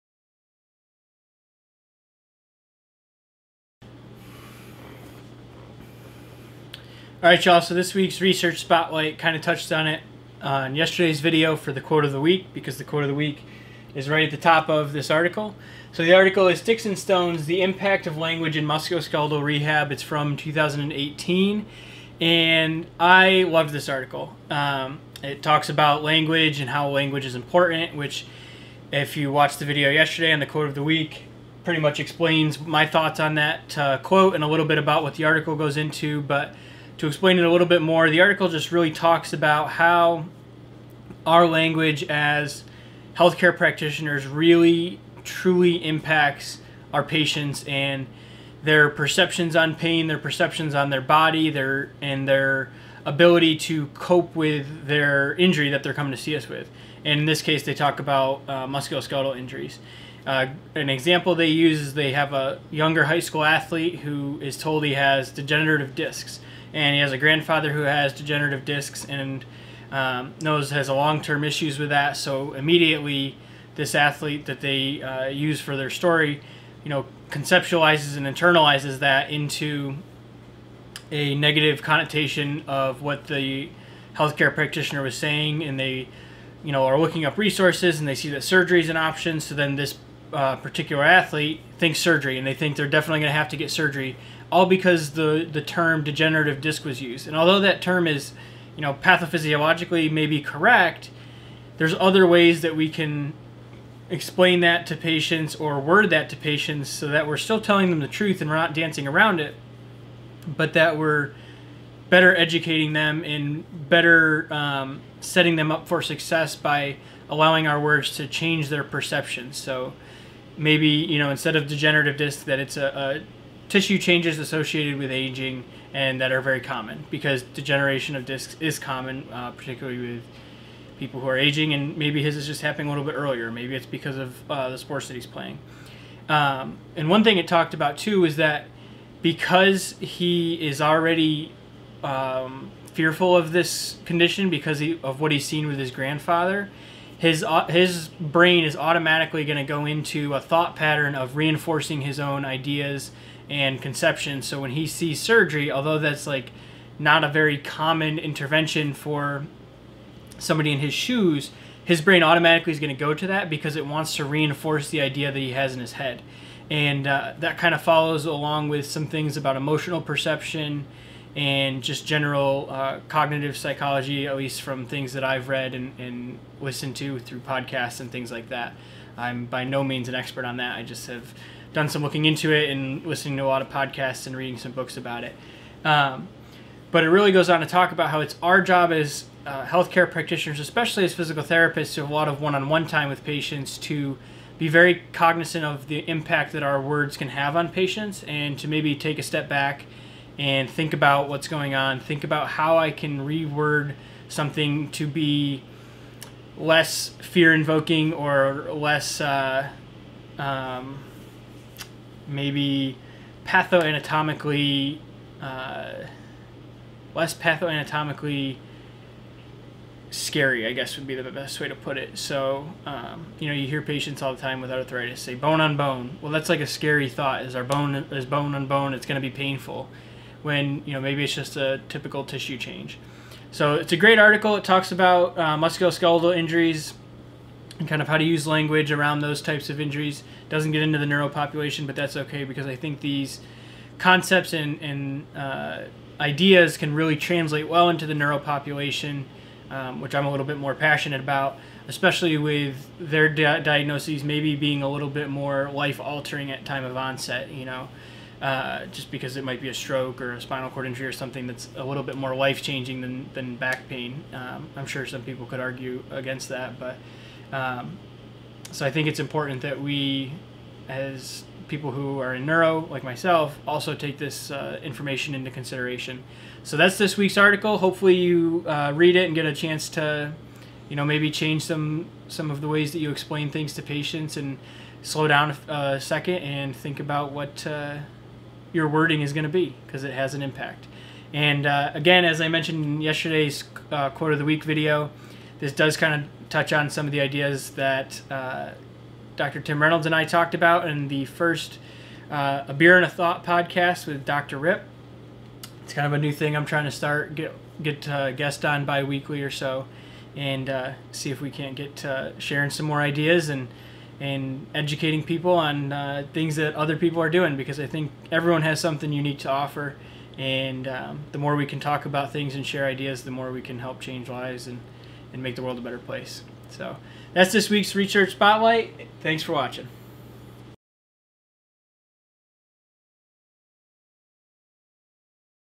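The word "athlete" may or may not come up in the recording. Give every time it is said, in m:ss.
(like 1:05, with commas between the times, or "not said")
1:03, 1:13, 1:31.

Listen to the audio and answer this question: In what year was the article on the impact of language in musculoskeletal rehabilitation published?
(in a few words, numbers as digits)
2018.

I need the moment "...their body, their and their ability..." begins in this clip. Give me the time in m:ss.
0:50.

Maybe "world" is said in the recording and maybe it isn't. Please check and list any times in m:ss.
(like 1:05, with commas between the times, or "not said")
5:25.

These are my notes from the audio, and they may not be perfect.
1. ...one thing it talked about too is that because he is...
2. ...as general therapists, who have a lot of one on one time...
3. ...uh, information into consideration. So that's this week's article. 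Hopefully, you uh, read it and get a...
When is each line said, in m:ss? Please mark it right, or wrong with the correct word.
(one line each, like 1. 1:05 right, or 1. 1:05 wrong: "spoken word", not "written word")
1. 2:17 right
2. 3:11 wrong: "physical", not "general"
3. 4:34 right.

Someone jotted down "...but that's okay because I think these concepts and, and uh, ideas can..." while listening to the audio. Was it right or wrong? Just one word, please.
right.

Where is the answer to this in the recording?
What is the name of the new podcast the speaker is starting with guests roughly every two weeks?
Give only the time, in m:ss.
5:02.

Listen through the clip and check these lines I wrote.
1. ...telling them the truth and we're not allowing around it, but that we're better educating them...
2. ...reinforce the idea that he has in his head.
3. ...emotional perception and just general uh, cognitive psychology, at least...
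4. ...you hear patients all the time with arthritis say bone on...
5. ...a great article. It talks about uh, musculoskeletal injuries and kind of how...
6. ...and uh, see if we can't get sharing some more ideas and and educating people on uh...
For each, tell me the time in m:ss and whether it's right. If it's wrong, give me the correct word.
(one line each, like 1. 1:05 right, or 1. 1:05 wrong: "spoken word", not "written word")
1. 1:47 wrong: "dancing", not "allowing"
2. 2:44 right
3. 2:49 right
4. 3:43 right
5. 3:53 right
6. 5:10 right.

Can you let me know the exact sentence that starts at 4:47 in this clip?
Uh, your wording is going to be because it has an impact.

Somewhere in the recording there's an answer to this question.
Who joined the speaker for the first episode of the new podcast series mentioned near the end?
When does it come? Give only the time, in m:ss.
4:59.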